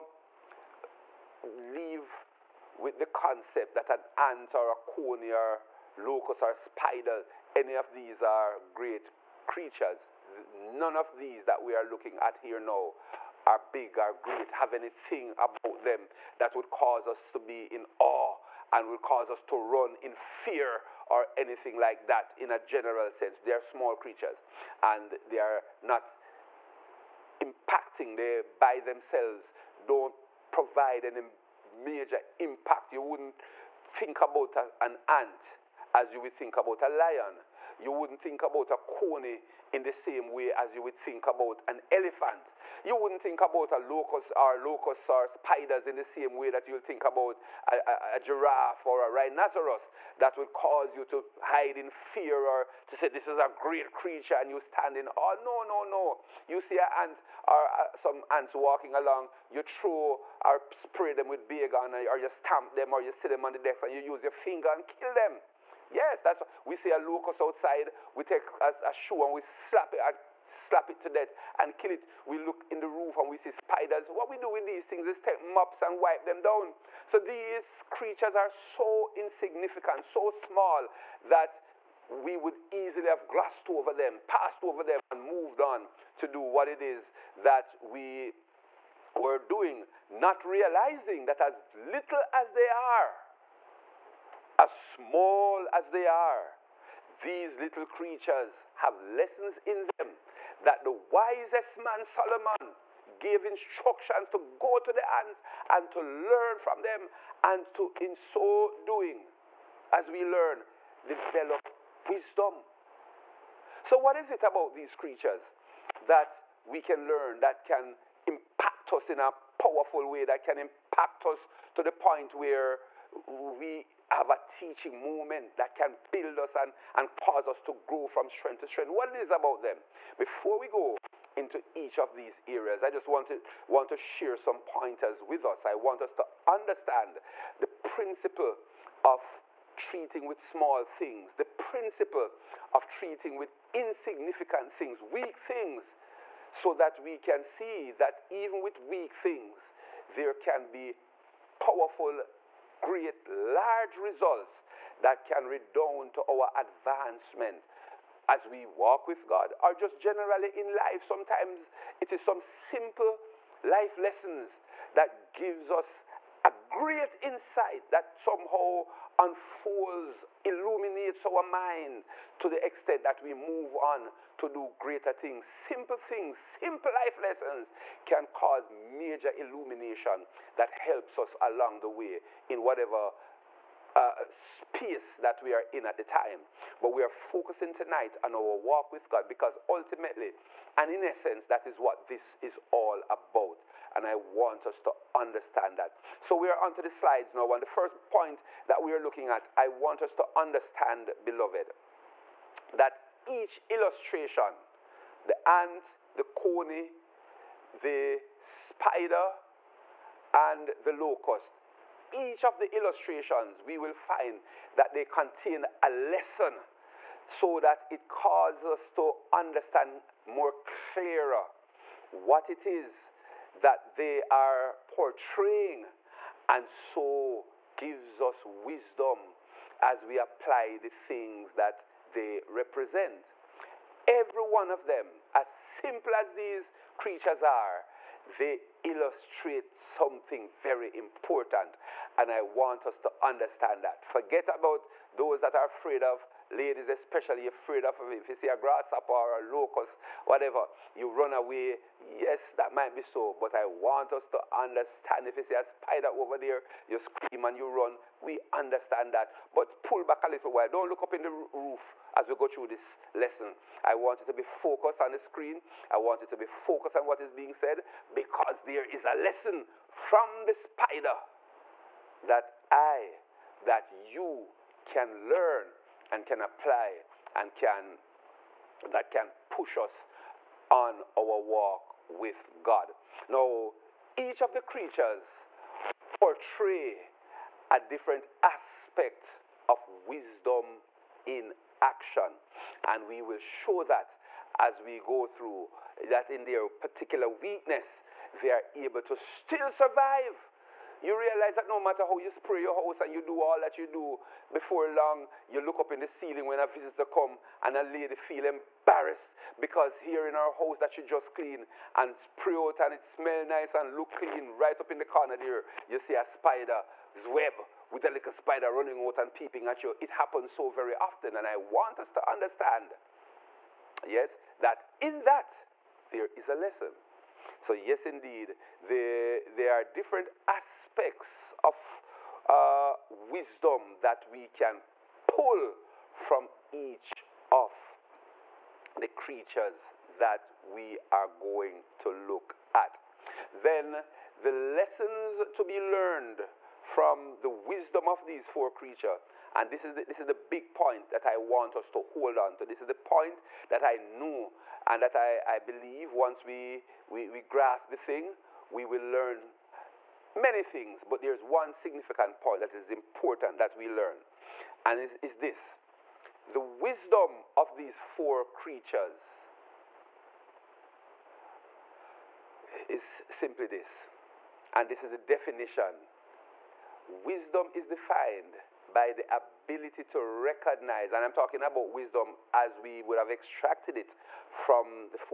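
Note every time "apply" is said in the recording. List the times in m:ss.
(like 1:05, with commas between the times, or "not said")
3:50, 4:36.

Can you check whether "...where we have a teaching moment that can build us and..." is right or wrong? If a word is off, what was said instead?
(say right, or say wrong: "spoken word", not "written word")
right.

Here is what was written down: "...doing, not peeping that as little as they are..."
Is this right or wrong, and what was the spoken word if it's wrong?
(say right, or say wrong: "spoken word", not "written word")
wrong: "realizing", not "peeping".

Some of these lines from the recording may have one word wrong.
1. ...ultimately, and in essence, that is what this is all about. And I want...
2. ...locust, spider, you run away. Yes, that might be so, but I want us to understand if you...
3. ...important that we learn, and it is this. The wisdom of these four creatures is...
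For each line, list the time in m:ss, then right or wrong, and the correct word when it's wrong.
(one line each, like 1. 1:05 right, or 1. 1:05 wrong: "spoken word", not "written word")
1. 3:09 right
2. 4:09 wrong: "whatever", not "spider"
3. 6:02 right.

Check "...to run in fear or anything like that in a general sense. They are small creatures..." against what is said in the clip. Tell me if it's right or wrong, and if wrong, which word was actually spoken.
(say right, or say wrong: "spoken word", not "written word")
right.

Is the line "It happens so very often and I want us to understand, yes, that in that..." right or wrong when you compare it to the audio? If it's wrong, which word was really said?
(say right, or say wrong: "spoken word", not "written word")
right.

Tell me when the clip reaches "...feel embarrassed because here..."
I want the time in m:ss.
5:08.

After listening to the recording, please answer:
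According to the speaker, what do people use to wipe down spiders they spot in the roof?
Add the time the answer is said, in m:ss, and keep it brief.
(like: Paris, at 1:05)
mops, at 1:15.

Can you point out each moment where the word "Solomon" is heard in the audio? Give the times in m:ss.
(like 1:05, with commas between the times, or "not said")
1:42.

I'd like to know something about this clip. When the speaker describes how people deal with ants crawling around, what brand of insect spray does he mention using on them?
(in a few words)
Baygon.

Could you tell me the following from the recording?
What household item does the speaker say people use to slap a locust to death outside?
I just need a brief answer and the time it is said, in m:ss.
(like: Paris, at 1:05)
a shoe, at 1:08.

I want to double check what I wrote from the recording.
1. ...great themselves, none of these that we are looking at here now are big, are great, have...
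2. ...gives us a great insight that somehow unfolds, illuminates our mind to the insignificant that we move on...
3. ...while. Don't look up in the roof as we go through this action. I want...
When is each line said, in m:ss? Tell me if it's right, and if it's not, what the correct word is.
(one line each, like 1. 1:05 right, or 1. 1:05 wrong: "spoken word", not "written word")
1. 0:08 wrong: "creatures", not "themselves"
2. 2:45 wrong: "extent", not "insignificant"
3. 4:20 wrong: "lesson", not "action".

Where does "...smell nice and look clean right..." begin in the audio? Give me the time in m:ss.
5:13.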